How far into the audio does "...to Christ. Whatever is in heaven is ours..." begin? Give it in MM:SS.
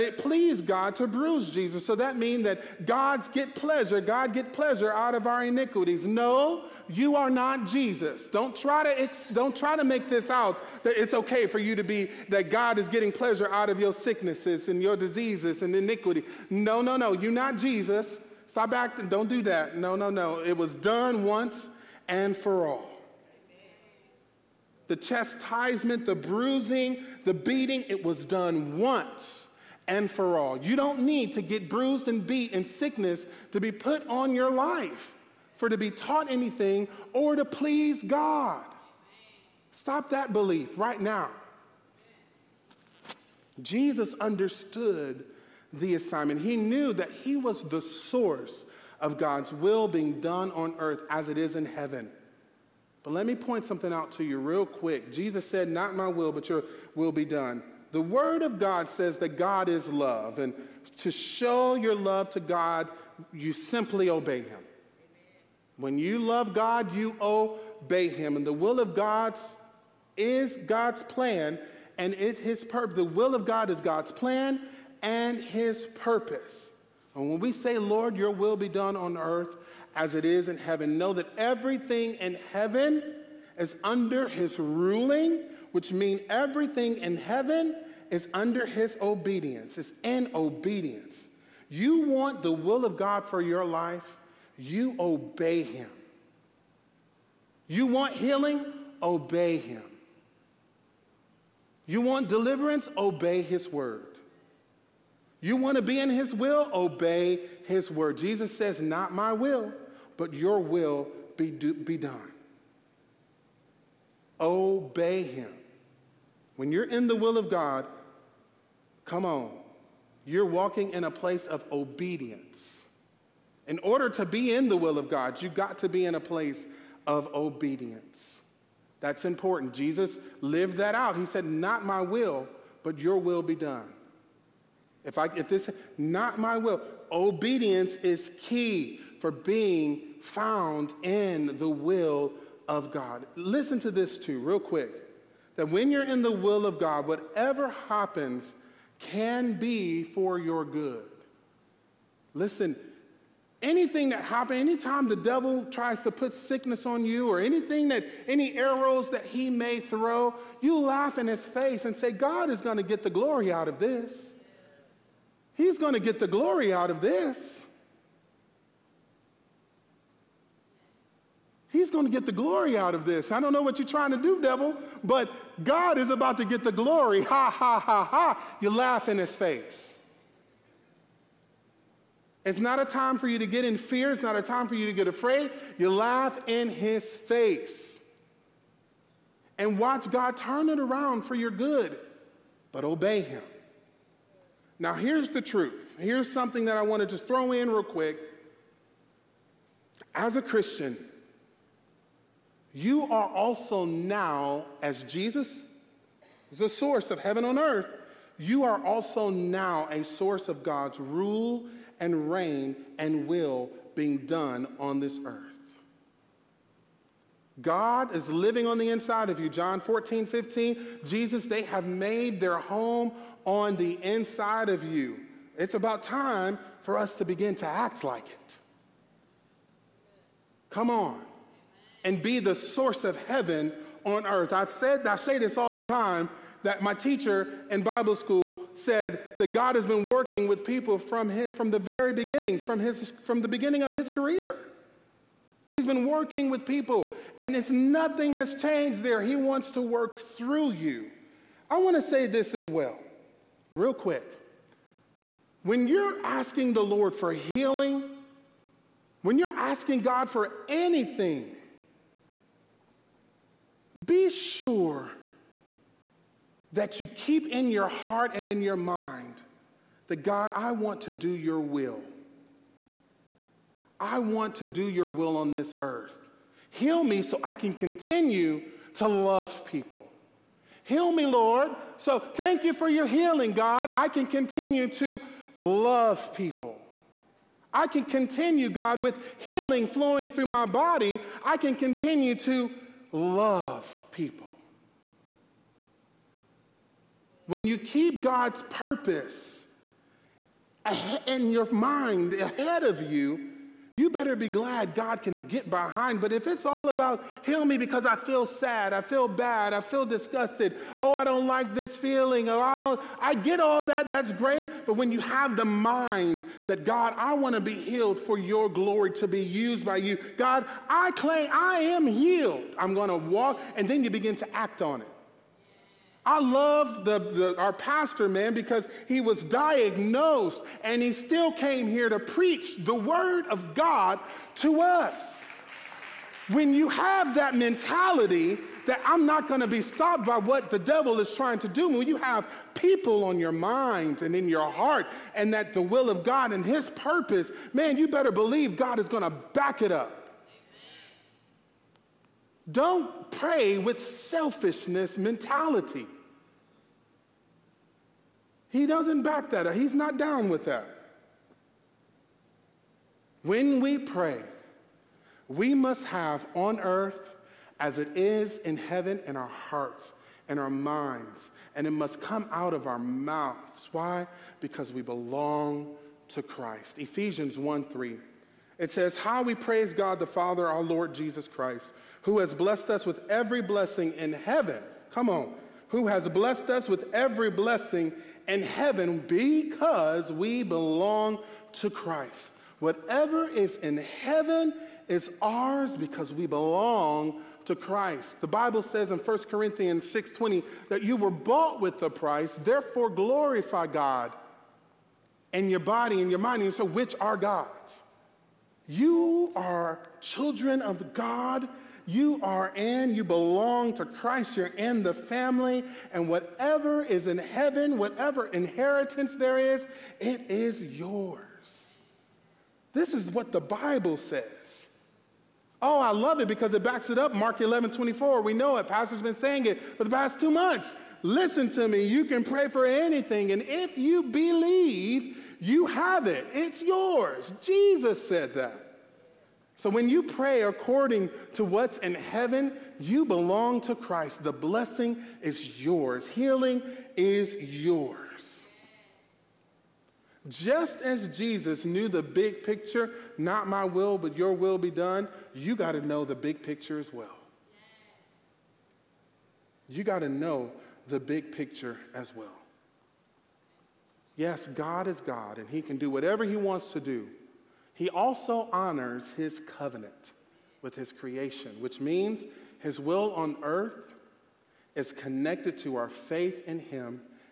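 06:31.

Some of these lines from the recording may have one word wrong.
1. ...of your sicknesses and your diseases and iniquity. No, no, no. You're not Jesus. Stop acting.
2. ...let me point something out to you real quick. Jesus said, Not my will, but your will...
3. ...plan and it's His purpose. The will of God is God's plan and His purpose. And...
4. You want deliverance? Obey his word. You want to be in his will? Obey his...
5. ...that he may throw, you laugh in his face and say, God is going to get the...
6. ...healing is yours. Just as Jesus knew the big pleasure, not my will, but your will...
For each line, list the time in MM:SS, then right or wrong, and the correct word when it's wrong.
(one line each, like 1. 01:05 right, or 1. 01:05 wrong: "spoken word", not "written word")
1. 00:13 right
2. 00:53 right
3. 01:11 right
4. 01:41 right
5. 02:39 right
6. 07:26 wrong: "picture", not "pleasure".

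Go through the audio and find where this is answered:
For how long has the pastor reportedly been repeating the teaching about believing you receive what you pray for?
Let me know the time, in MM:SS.
07:10.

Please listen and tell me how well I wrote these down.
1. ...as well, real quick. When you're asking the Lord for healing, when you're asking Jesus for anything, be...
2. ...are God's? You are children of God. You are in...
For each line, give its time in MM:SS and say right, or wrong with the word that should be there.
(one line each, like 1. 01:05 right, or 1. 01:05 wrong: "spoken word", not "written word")
1. 04:12 wrong: "God", not "Jesus"
2. 06:47 right.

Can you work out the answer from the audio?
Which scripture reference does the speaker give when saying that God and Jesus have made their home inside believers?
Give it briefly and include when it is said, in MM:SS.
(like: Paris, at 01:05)
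John 14:15, at 03:39.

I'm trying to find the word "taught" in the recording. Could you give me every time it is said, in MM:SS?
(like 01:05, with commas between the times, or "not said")
00:35.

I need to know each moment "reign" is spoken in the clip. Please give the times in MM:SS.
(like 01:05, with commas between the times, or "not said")
03:32.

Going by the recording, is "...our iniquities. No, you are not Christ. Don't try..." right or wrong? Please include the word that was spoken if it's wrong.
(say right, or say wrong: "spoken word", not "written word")
wrong: "Jesus", not "Christ".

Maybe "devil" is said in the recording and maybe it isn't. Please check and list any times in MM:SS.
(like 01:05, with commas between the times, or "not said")
02:35, 02:54, 05:40.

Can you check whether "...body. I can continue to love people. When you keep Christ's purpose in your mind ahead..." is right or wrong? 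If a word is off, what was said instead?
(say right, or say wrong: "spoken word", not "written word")
wrong: "God", not "Christ".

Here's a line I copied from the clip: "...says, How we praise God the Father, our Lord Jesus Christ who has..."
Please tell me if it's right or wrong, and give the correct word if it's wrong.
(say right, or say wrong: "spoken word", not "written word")
right.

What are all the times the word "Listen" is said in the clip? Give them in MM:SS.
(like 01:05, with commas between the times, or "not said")
02:23, 02:32, 07:11.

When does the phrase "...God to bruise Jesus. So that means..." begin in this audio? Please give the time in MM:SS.
00:00.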